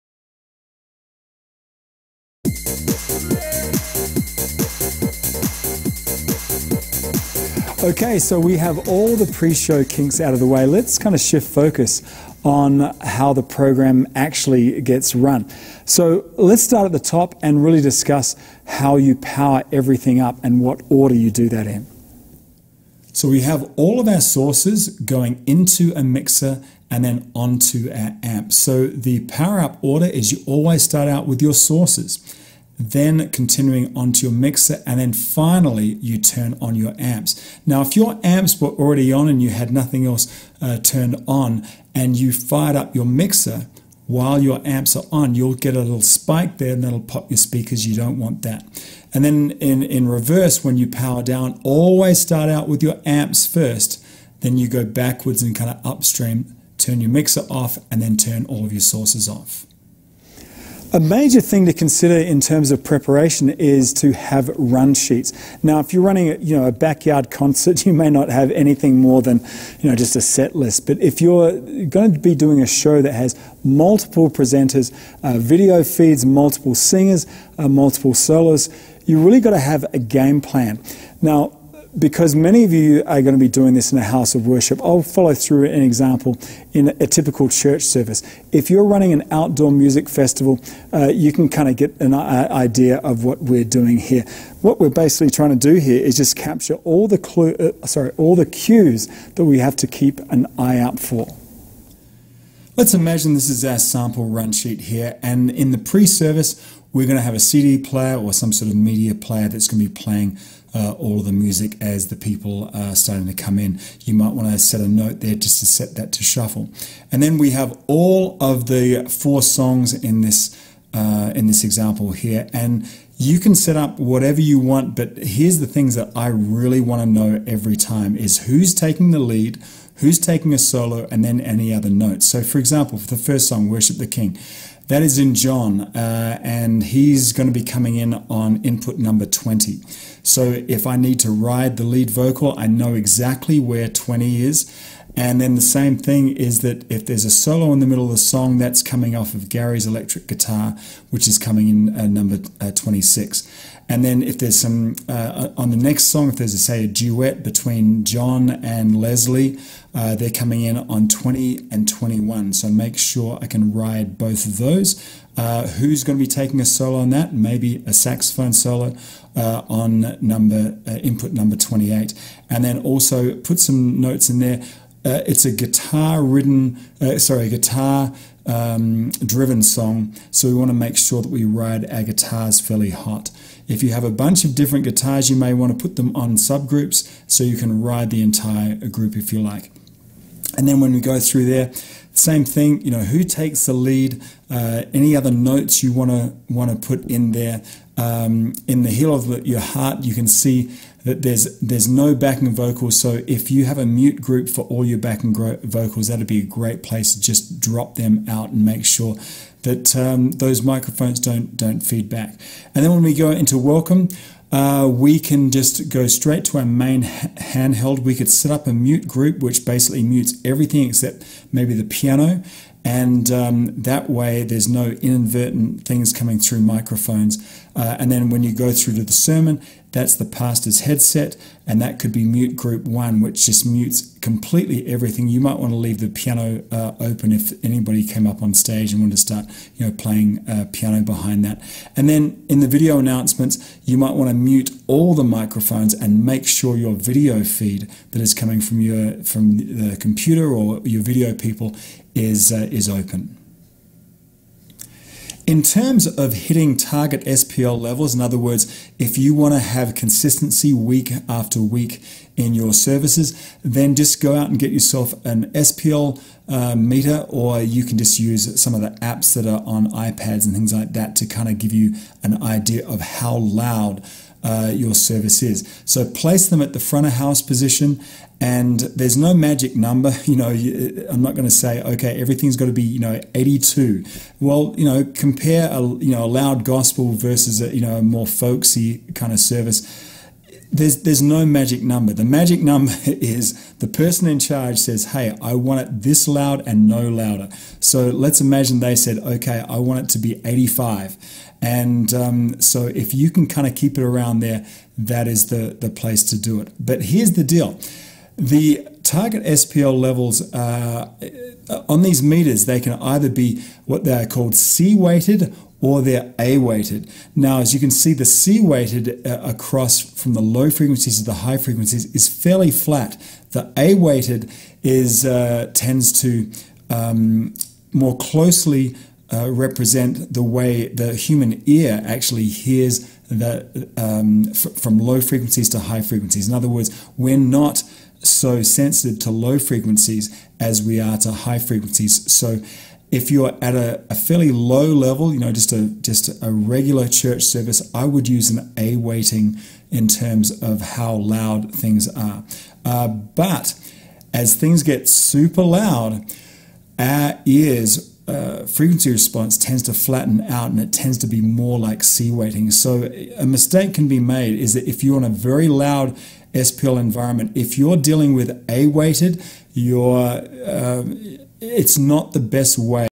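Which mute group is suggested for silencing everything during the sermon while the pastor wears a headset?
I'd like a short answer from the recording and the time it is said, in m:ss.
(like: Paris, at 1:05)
Mute group 1, at 3:52.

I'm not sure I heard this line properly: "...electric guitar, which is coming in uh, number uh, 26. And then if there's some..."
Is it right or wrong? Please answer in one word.
right.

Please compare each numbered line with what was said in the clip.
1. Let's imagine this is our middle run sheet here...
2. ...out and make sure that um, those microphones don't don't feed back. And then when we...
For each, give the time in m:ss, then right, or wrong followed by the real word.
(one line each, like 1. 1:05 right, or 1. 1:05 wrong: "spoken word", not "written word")
1. 1:42 wrong: "sample", not "middle"
2. 3:28 right.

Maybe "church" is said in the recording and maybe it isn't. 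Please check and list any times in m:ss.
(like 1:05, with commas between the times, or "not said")
1:27, 5:47.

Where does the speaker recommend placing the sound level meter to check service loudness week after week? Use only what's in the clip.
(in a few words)
Front of house position.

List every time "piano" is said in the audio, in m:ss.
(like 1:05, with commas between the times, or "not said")
3:41, 3:56, 4:00.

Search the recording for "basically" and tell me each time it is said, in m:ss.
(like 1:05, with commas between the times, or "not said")
1:34, 3:39.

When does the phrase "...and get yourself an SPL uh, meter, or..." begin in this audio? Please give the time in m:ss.
4:24.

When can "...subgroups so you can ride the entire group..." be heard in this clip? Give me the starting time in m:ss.
3:06.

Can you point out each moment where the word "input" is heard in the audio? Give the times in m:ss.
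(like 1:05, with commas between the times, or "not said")
2:18, 2:50.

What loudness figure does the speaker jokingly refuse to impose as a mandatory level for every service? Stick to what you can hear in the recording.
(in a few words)
82.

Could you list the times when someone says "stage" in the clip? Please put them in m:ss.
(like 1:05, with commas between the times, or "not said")
3:58.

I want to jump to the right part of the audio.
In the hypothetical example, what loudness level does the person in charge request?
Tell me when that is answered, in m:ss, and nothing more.
5:00.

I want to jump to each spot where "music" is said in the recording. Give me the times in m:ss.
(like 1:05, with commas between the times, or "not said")
1:29, 1:51.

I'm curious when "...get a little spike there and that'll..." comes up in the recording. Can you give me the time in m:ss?
0:45.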